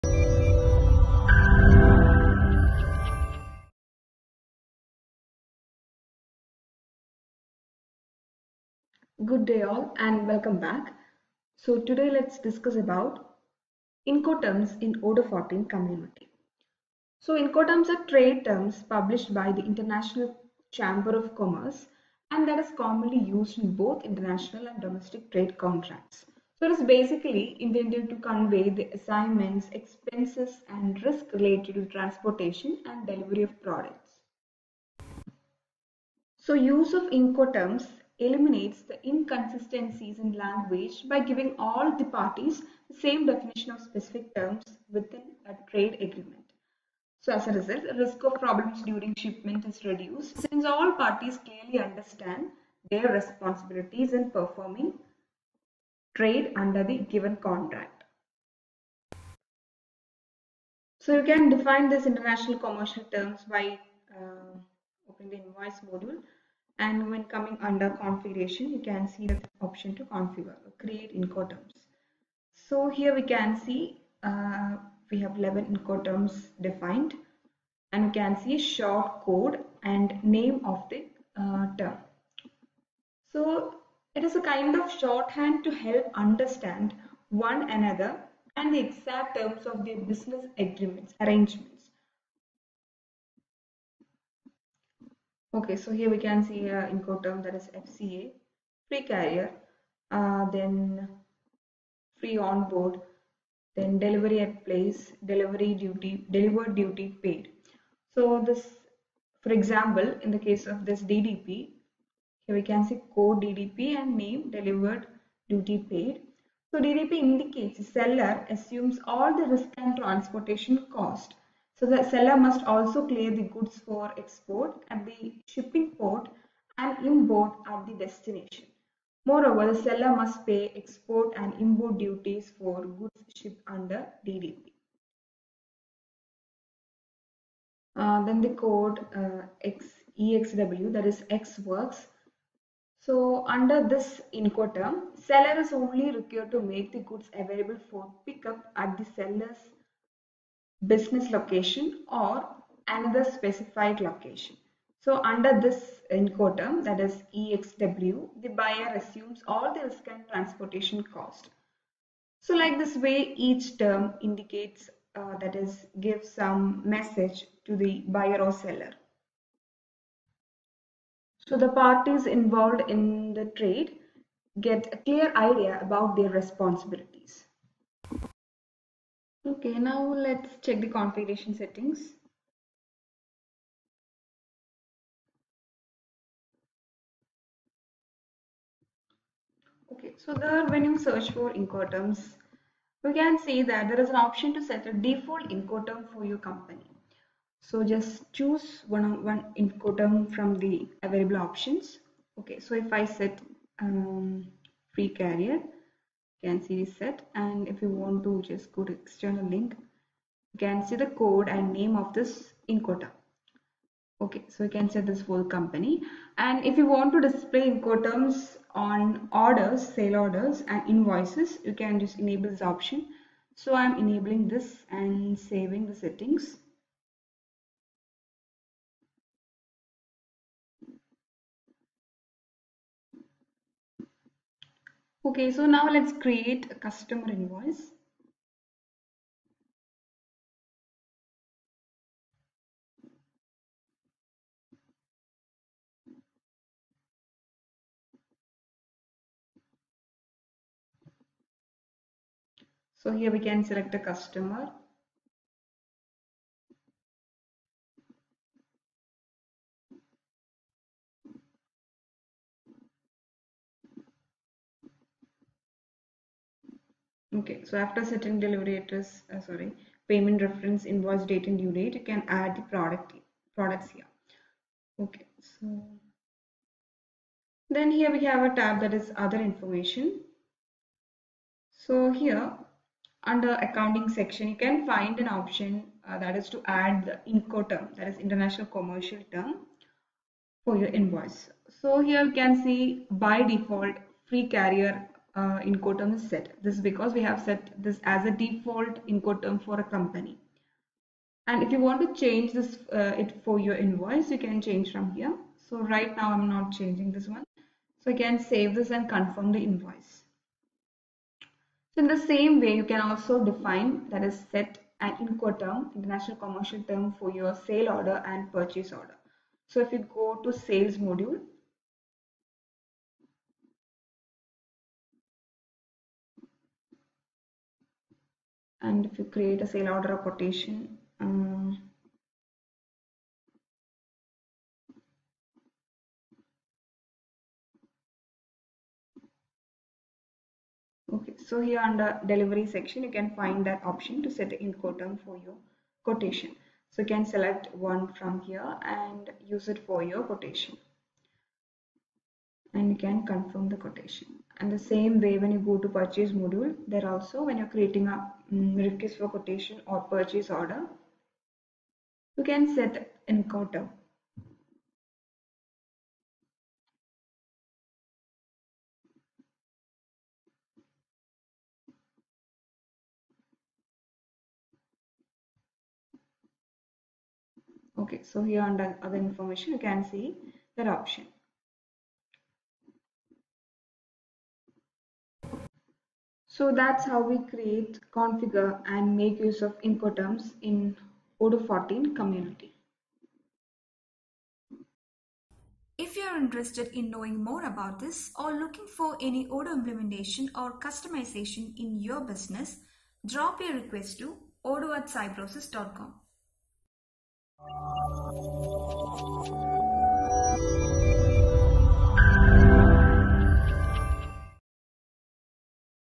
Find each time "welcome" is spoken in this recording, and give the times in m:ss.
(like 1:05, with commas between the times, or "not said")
0:10.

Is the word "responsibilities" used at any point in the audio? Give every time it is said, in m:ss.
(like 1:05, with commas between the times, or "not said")
0:53, 2:56.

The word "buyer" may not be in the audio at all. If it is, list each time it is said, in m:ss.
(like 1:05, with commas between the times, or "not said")
2:38, 2:48.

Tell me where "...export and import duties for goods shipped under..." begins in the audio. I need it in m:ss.
2:10.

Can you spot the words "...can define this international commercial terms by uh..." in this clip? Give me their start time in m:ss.
1:01.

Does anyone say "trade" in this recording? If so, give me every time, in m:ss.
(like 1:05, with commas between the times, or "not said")
0:18, 0:25, 0:45, 0:56, 2:53.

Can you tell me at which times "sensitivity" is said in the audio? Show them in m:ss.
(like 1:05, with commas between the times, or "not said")
not said.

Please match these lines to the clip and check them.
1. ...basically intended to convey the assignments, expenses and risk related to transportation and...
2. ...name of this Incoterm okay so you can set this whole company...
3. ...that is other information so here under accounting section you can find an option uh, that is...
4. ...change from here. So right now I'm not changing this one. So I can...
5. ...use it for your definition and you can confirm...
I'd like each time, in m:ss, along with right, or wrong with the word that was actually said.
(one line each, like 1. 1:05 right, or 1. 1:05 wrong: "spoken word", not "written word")
1. 0:26 right
2. 3:31 right
3. 4:38 right
4. 5:04 right
5. 5:49 wrong: "quotation", not "definition".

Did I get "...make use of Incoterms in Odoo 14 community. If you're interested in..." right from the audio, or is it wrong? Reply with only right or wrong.
right.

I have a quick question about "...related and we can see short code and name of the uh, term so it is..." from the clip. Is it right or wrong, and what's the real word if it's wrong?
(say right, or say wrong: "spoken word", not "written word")
wrong: "defined", not "related".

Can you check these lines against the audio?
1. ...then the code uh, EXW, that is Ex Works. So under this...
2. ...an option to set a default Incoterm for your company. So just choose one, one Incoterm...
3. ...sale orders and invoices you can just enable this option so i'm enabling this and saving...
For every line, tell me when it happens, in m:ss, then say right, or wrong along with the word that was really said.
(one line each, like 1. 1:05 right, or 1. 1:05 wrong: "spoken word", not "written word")
1. 2:18 right
2. 3:14 right
3. 3:39 right.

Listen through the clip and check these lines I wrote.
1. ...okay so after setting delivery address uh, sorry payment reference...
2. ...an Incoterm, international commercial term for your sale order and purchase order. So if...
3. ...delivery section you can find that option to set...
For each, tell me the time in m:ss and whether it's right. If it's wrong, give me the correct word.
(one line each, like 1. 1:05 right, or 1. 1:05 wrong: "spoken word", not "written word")
1. 4:27 right
2. 5:15 right
3. 5:42 right.